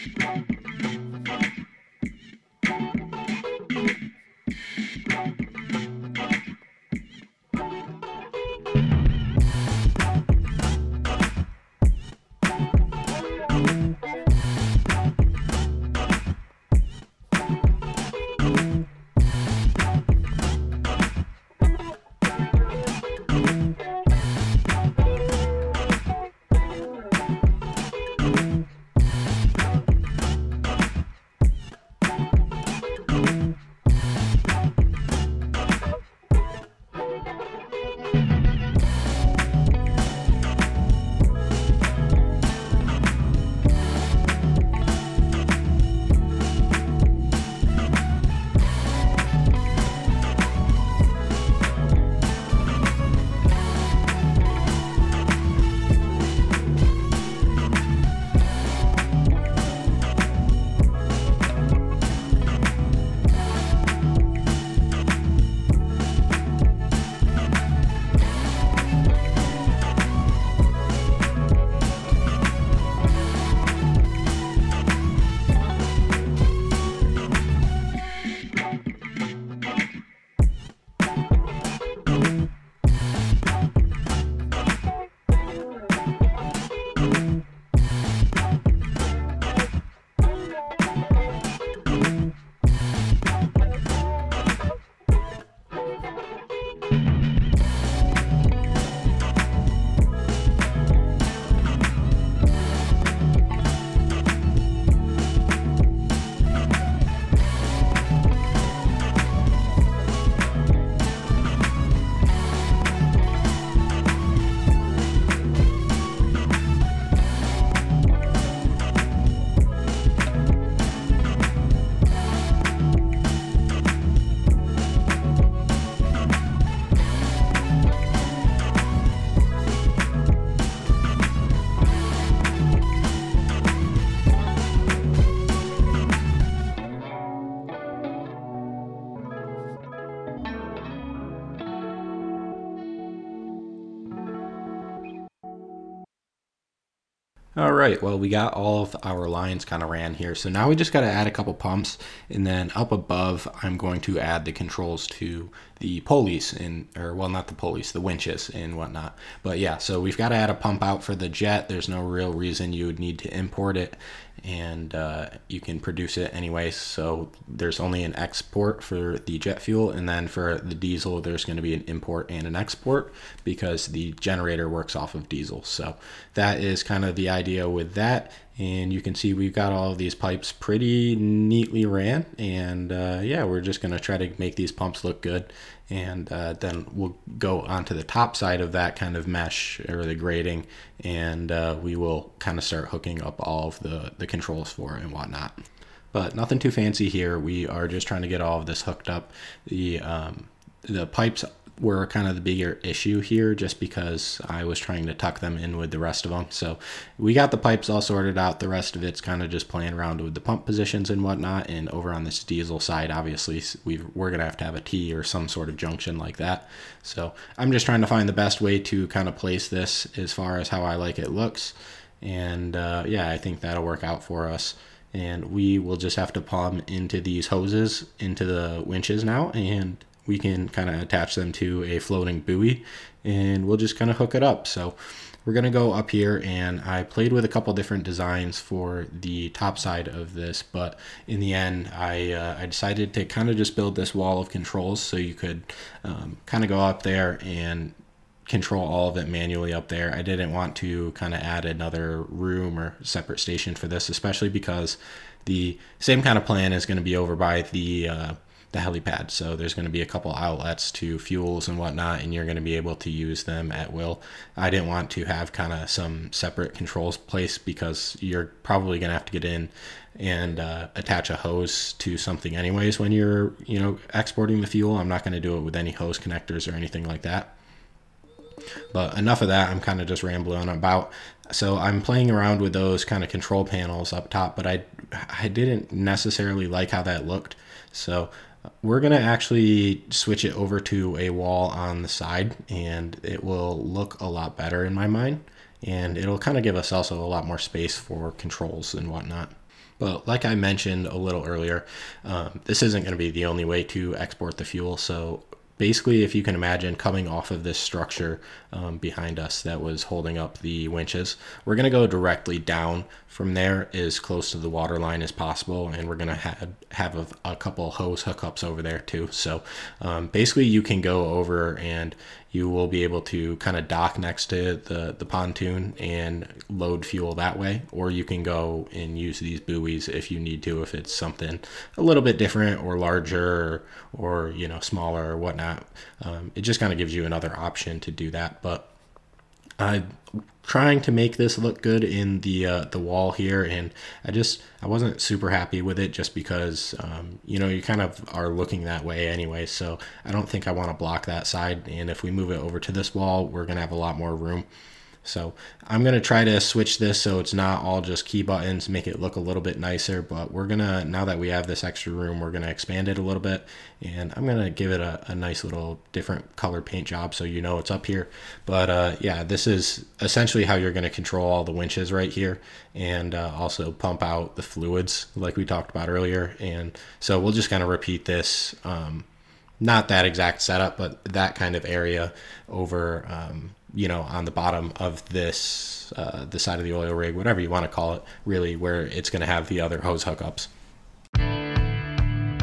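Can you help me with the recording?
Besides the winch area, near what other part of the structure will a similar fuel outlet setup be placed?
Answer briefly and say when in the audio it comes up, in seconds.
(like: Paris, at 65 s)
the helipad, at 258 s.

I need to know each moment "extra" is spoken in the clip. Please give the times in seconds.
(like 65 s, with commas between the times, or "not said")
361 s.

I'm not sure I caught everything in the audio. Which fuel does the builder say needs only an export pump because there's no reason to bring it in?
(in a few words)
jet fuel.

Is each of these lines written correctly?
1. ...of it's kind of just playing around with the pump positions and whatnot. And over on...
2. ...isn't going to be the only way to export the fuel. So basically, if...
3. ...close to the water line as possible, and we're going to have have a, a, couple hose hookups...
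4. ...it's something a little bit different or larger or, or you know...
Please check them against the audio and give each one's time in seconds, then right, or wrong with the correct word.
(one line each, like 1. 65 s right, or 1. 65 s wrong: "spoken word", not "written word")
1. 208 s right
2. 302 s right
3. 314 s right
4. 330 s right.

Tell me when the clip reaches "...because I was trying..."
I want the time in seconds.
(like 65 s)
203 s.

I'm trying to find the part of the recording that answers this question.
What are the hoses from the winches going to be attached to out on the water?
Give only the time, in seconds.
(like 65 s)
231 s.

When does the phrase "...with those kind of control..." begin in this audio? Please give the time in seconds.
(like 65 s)
282 s.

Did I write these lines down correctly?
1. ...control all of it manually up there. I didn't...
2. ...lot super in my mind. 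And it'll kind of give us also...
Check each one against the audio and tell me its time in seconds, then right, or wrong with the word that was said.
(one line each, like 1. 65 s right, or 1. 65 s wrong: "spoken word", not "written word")
1. 248 s right
2. 294 s wrong: "better", not "super".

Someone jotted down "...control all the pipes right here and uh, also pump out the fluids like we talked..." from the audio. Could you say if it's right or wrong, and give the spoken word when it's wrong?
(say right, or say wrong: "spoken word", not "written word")
wrong: "winches", not "pipes".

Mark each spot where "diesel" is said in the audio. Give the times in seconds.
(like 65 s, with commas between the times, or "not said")
170 s, 175 s, 212 s.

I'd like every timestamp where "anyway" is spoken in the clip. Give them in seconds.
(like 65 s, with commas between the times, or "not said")
166 s, 272 s, 349 s.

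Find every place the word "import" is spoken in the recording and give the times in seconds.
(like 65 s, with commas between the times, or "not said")
163 s, 171 s.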